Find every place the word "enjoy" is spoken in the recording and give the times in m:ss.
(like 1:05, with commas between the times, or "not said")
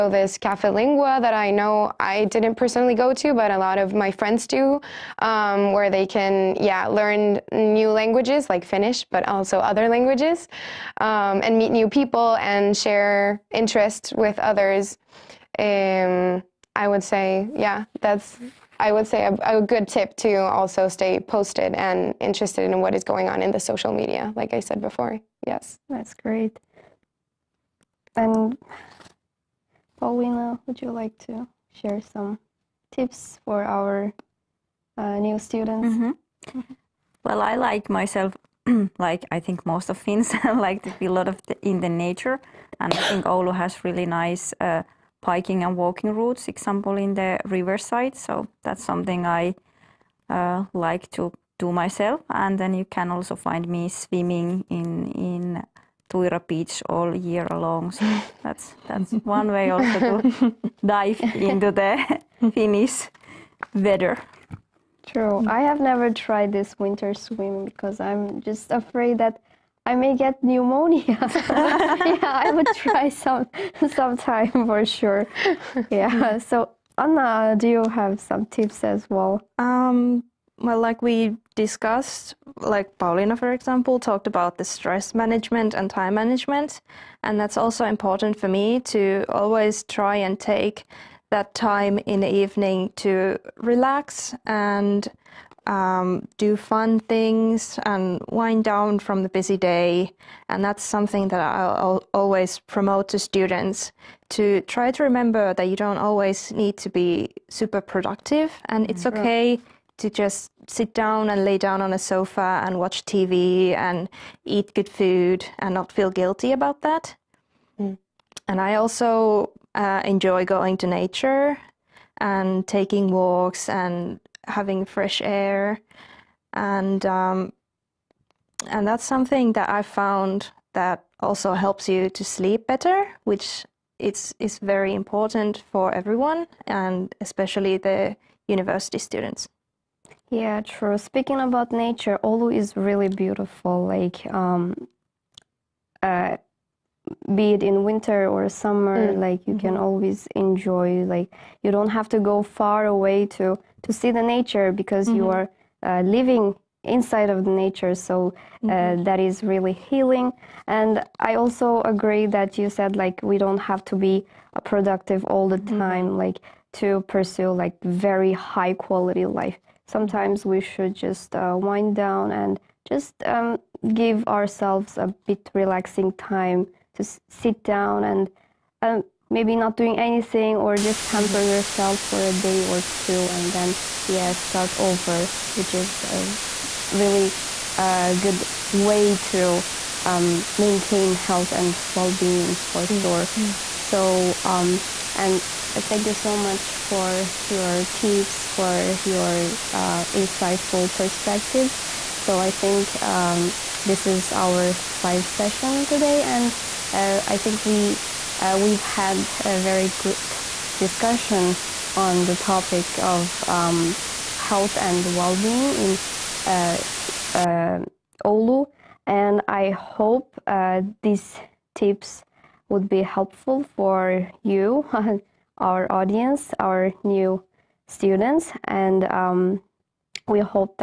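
2:00, 2:30.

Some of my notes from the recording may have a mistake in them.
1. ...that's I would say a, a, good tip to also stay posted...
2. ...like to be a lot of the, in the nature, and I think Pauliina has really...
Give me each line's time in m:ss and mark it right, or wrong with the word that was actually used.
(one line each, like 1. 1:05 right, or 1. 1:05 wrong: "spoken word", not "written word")
1. 0:18 right
2. 0:40 wrong: "Oulu", not "Pauliina".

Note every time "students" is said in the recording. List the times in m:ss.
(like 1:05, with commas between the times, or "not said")
0:35, 1:43, 2:18, 3:47.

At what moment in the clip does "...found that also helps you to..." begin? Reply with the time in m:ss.
2:09.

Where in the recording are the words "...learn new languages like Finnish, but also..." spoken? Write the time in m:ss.
0:06.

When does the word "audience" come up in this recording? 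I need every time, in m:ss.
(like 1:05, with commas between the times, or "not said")
3:45.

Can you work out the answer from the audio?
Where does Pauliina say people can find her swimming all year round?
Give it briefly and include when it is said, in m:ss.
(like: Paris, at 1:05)
Tuira Beach, at 0:56.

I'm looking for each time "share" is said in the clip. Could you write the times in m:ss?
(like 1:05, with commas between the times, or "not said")
0:12, 0:31.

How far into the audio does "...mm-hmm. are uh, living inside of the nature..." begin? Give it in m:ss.
2:35.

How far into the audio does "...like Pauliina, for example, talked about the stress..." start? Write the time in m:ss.
1:22.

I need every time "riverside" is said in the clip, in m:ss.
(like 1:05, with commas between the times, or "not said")
0:47.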